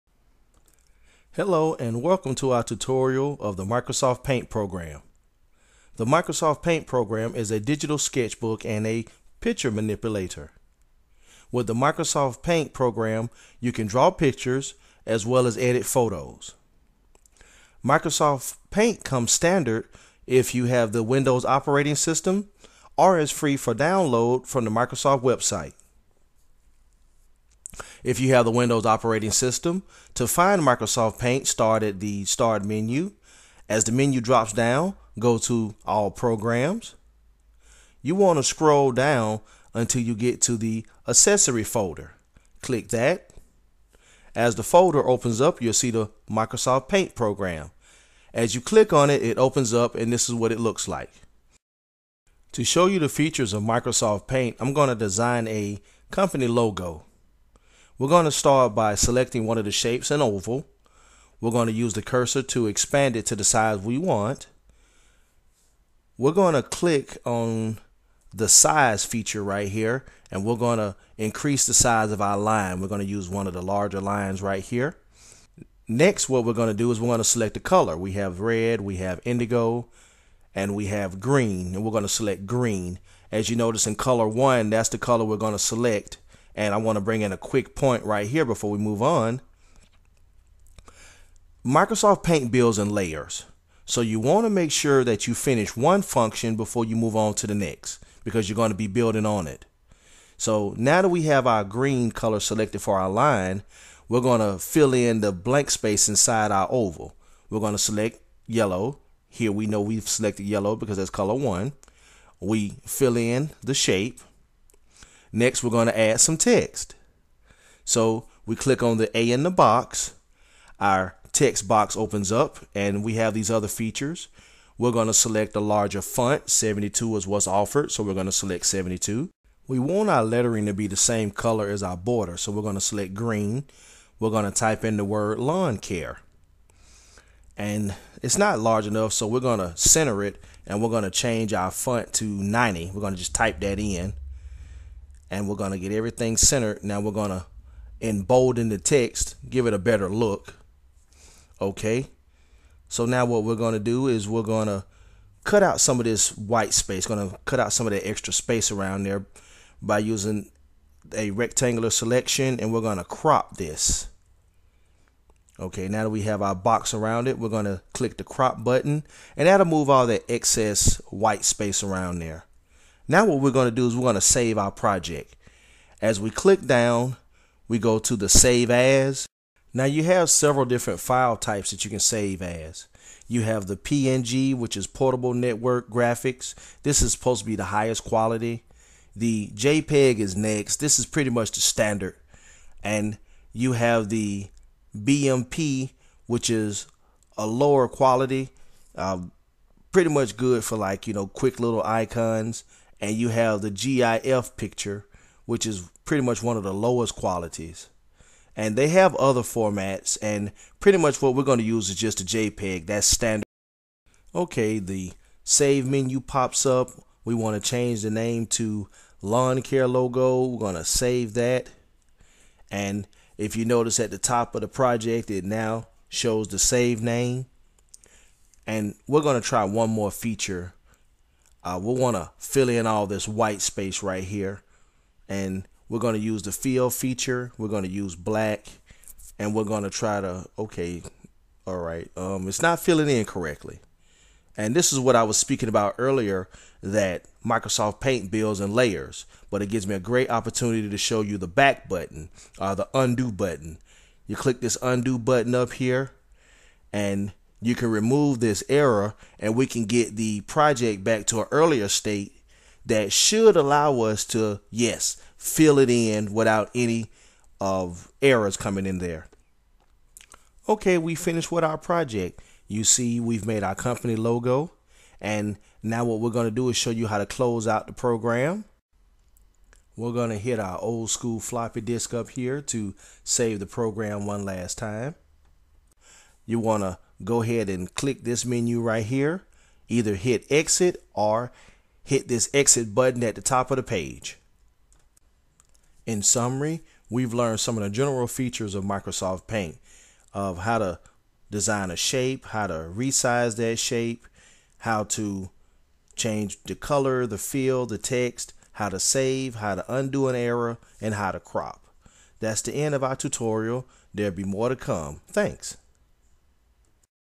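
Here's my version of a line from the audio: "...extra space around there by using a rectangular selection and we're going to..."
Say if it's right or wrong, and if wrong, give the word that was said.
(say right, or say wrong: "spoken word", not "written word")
right.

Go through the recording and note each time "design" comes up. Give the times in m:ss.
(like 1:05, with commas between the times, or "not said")
0:54, 5:01.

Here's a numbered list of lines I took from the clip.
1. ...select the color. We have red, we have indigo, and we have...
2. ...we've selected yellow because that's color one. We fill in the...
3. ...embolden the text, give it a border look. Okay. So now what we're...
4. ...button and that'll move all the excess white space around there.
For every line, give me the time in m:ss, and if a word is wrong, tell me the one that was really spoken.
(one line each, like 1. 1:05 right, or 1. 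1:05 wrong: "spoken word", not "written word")
1. 1:17 right
2. 1:49 right
3. 2:28 wrong: "better", not "border"
4. 2:48 right.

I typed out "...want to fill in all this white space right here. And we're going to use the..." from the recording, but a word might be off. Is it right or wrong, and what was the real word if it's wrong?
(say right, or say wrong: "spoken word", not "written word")
right.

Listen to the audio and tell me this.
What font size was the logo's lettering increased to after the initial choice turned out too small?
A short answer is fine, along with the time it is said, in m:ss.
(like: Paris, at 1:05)
90, at 2:22.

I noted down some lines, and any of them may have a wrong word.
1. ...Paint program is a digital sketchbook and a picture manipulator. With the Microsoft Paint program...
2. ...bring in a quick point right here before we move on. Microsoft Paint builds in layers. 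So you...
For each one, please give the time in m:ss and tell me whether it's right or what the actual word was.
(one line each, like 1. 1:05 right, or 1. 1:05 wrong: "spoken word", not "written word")
1. 0:06 right
2. 1:27 right.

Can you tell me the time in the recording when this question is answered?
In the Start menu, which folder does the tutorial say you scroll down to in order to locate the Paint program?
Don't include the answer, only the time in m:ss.
0:41.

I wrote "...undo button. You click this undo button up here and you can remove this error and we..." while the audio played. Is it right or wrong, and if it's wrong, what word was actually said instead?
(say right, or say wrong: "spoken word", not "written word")
right.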